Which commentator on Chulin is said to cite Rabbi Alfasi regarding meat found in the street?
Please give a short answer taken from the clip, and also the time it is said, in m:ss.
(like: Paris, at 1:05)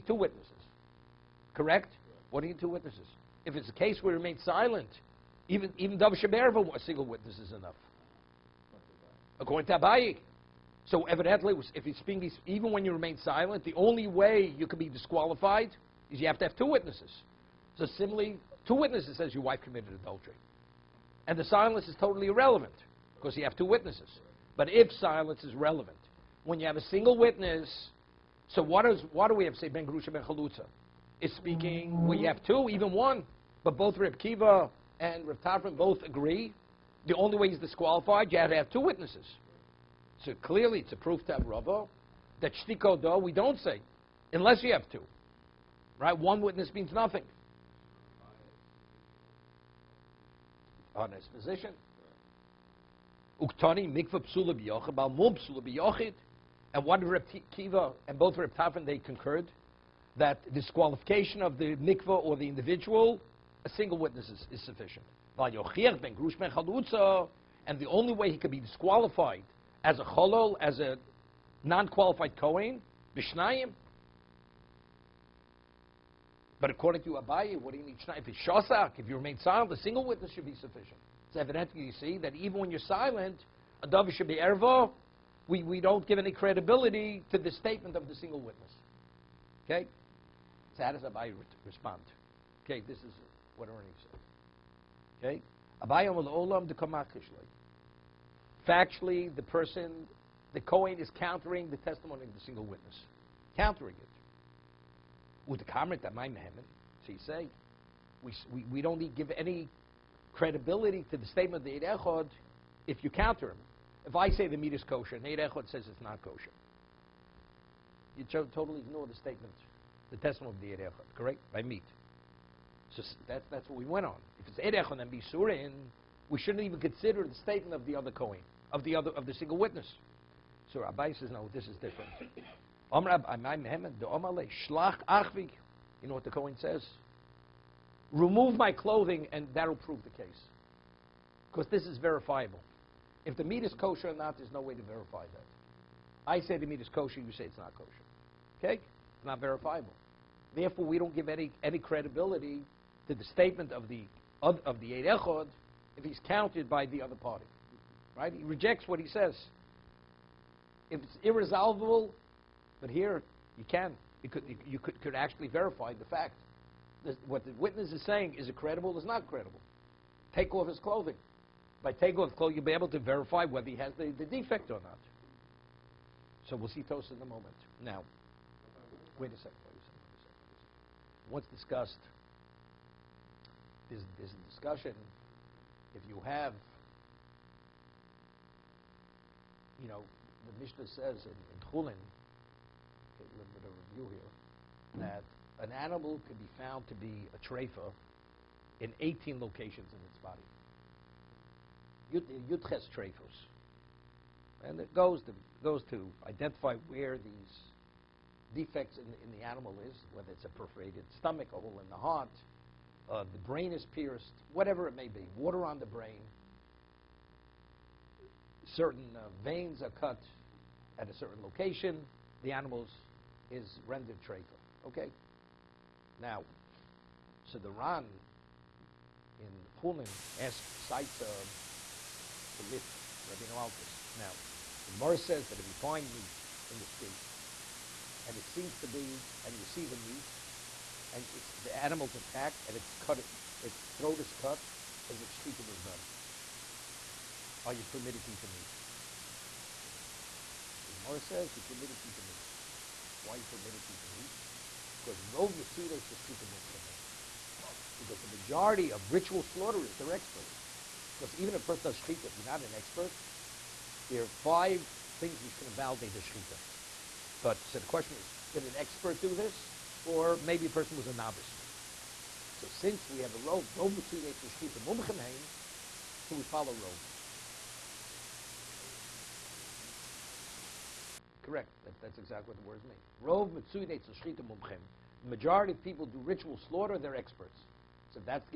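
The Ran, at 3:47.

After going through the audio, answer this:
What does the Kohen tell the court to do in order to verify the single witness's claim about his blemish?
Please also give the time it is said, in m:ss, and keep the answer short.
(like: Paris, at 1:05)
Remove my clothing, at 2:18.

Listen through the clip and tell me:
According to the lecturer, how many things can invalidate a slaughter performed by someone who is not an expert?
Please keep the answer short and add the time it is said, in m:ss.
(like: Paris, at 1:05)
5, at 4:24.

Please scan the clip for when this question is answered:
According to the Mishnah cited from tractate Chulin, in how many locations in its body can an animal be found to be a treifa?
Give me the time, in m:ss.
3:19.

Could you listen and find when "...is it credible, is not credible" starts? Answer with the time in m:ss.
2:48.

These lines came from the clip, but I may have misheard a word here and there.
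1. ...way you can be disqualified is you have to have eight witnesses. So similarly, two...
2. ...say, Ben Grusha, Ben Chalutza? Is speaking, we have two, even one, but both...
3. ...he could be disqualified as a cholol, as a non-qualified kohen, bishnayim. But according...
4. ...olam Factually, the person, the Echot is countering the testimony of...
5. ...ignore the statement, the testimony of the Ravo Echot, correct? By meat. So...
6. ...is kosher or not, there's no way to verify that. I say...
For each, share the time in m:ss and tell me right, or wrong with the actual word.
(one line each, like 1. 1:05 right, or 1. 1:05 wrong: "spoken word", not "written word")
1. 0:14 wrong: "two", not "eight"
2. 0:29 right
3. 1:08 right
4. 1:36 wrong: "Kohen", not "Echot"
5. 1:58 wrong: "Eir", not "Ravo"
6. 2:23 right.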